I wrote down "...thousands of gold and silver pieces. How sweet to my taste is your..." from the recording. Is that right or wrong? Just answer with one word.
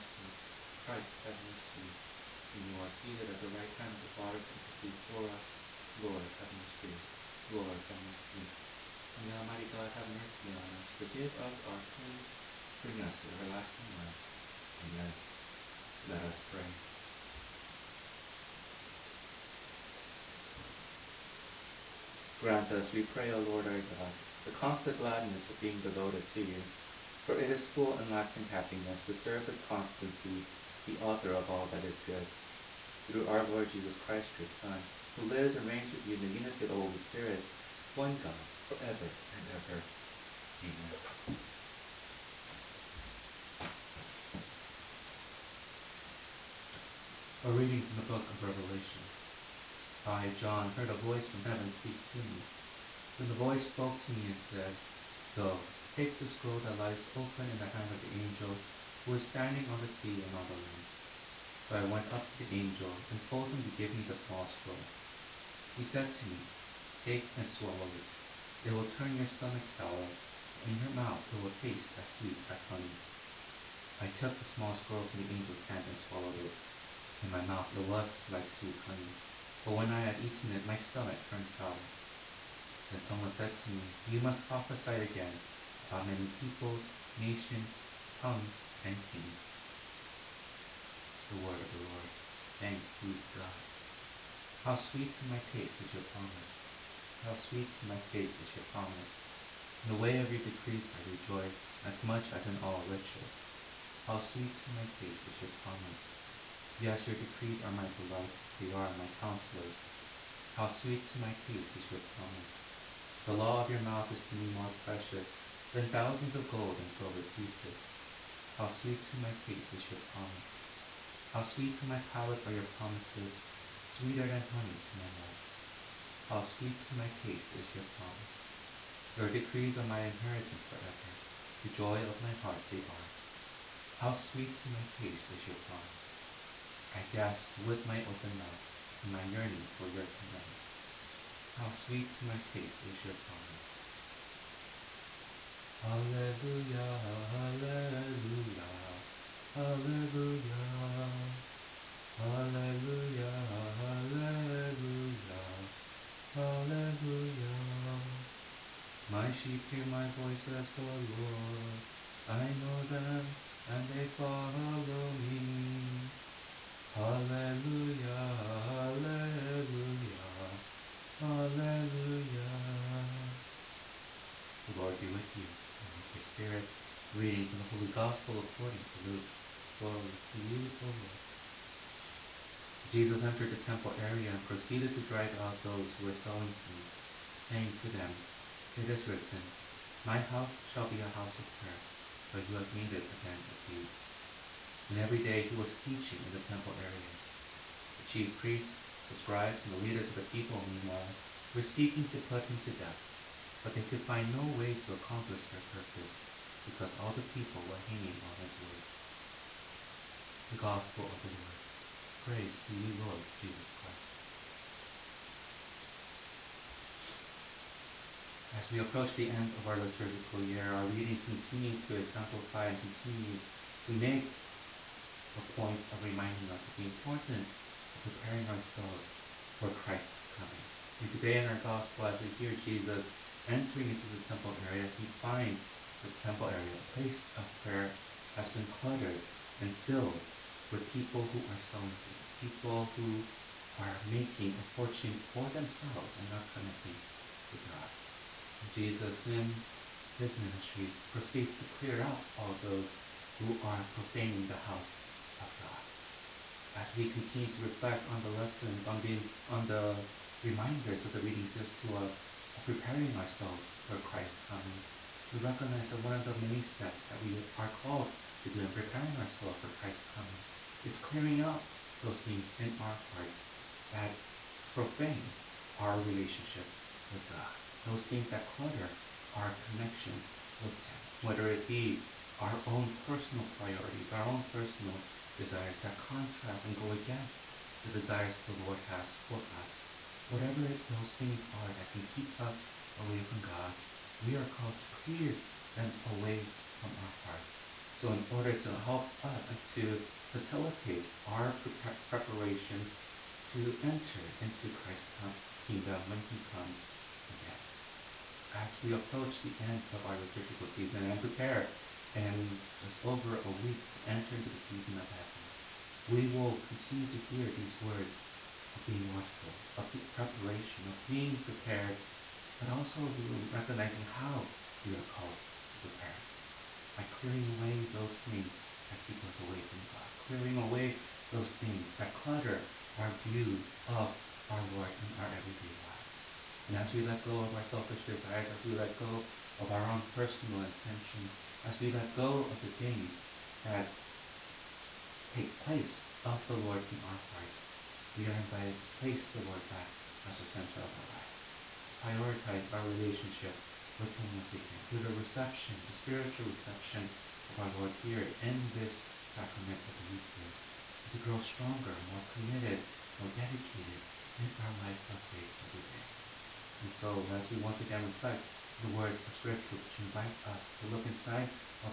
right.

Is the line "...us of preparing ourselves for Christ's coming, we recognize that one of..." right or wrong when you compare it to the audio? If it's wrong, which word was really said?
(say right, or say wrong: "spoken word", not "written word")
right.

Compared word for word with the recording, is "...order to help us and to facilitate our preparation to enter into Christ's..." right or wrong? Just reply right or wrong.
right.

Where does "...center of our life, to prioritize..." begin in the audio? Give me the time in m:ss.
5:50.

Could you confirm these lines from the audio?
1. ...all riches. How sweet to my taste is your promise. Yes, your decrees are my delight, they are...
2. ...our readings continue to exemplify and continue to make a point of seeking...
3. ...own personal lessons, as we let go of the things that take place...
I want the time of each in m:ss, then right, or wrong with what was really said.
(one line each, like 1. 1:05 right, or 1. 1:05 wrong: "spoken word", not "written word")
1. 1:42 right
2. 3:40 wrong: "reminding", not "seeking"
3. 5:39 wrong: "intentions", not "lessons".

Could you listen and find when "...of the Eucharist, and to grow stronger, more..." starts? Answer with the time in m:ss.
5:59.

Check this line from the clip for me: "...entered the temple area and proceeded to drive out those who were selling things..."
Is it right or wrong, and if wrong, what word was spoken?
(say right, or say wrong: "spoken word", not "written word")
right.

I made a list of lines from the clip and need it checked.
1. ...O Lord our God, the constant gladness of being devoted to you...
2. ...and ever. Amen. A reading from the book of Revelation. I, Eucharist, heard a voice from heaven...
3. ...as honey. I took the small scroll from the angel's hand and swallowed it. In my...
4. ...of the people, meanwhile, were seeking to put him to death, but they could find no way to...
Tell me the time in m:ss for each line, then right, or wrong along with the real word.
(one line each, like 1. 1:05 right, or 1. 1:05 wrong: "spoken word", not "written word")
1. 0:23 right
2. 0:39 wrong: "John", not "Eucharist"
3. 1:12 right
4. 3:20 right.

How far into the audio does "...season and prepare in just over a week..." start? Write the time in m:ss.
5:10.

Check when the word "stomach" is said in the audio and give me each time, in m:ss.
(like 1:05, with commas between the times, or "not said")
1:09, 1:20.